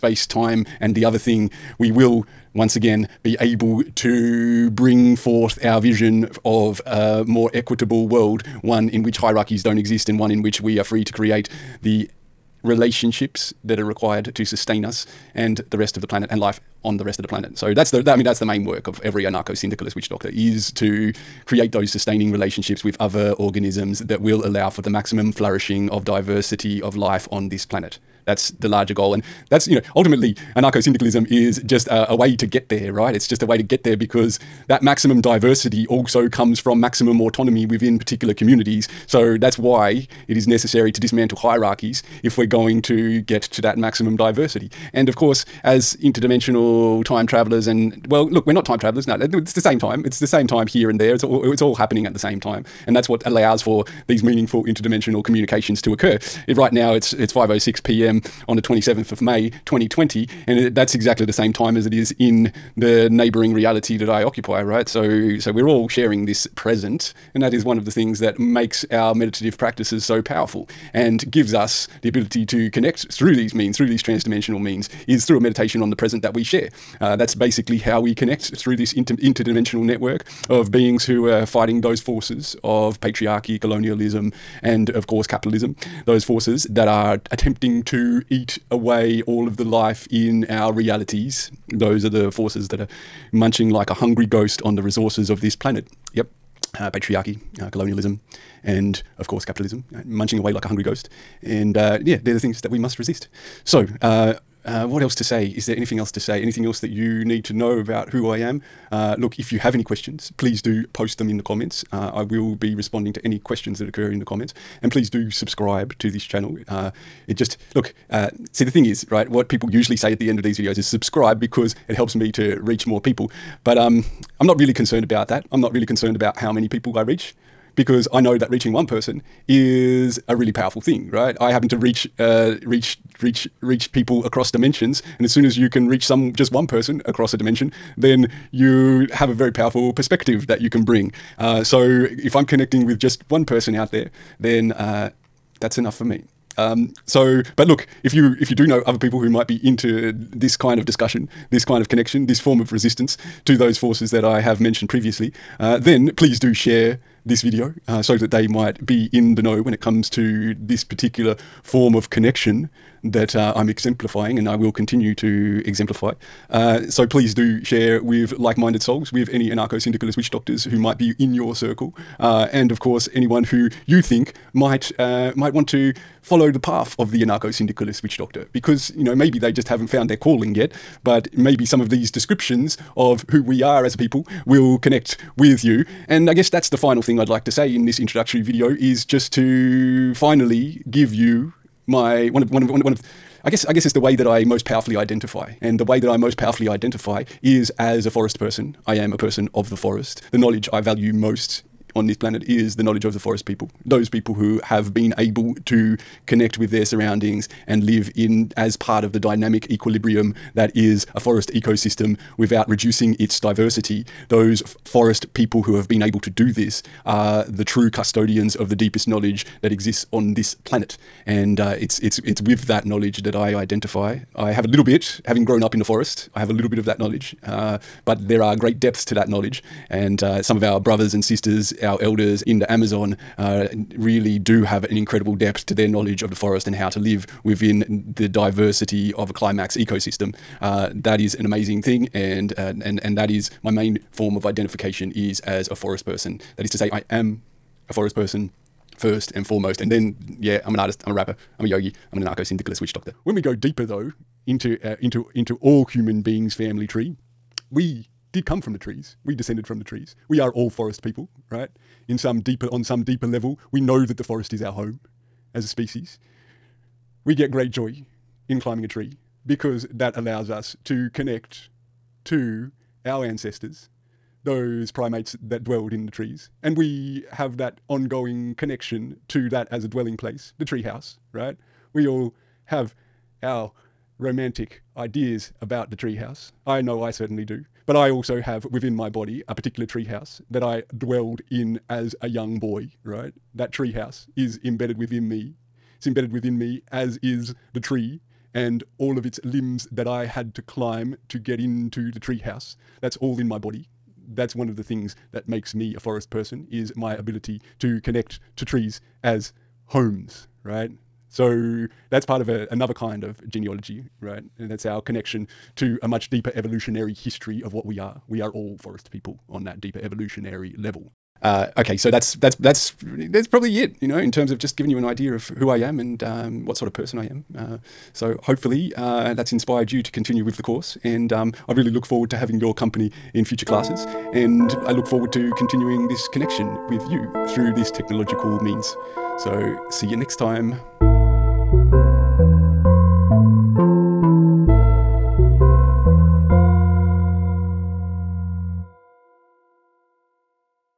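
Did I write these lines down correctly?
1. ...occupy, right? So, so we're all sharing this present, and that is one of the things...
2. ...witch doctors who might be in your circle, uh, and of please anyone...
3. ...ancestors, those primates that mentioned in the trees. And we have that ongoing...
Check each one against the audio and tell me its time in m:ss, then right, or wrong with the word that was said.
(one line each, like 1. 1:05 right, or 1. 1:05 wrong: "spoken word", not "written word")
1. 1:04 right
2. 2:50 wrong: "course", not "please"
3. 4:33 wrong: "dwelled", not "mentioned".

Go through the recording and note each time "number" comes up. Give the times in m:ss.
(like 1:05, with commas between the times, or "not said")
not said.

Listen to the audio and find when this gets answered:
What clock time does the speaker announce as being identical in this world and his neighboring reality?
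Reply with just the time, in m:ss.
0:57.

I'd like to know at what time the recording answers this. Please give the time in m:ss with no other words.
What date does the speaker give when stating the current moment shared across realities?
0:58.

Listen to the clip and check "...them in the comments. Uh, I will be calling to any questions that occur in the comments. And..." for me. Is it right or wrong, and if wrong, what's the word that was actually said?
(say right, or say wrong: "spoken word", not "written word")
wrong: "responding", not "calling".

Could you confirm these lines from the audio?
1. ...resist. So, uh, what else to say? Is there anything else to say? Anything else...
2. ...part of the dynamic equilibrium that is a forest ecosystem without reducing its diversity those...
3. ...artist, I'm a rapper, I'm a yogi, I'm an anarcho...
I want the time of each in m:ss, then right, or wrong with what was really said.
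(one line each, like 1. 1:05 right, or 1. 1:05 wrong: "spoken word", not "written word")
1. 1:42 right
2. 3:28 right
3. 4:10 right.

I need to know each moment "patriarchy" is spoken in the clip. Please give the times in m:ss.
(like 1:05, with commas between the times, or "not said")
1:22, 1:36.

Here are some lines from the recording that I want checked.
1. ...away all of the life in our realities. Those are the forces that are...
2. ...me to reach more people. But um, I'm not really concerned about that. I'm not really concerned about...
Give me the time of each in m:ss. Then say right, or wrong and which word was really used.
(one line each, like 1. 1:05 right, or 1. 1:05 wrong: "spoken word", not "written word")
1. 1:28 right
2. 2:02 right.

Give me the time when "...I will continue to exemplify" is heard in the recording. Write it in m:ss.
2:44.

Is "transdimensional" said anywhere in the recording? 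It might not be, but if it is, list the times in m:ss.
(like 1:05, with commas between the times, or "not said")
1:14.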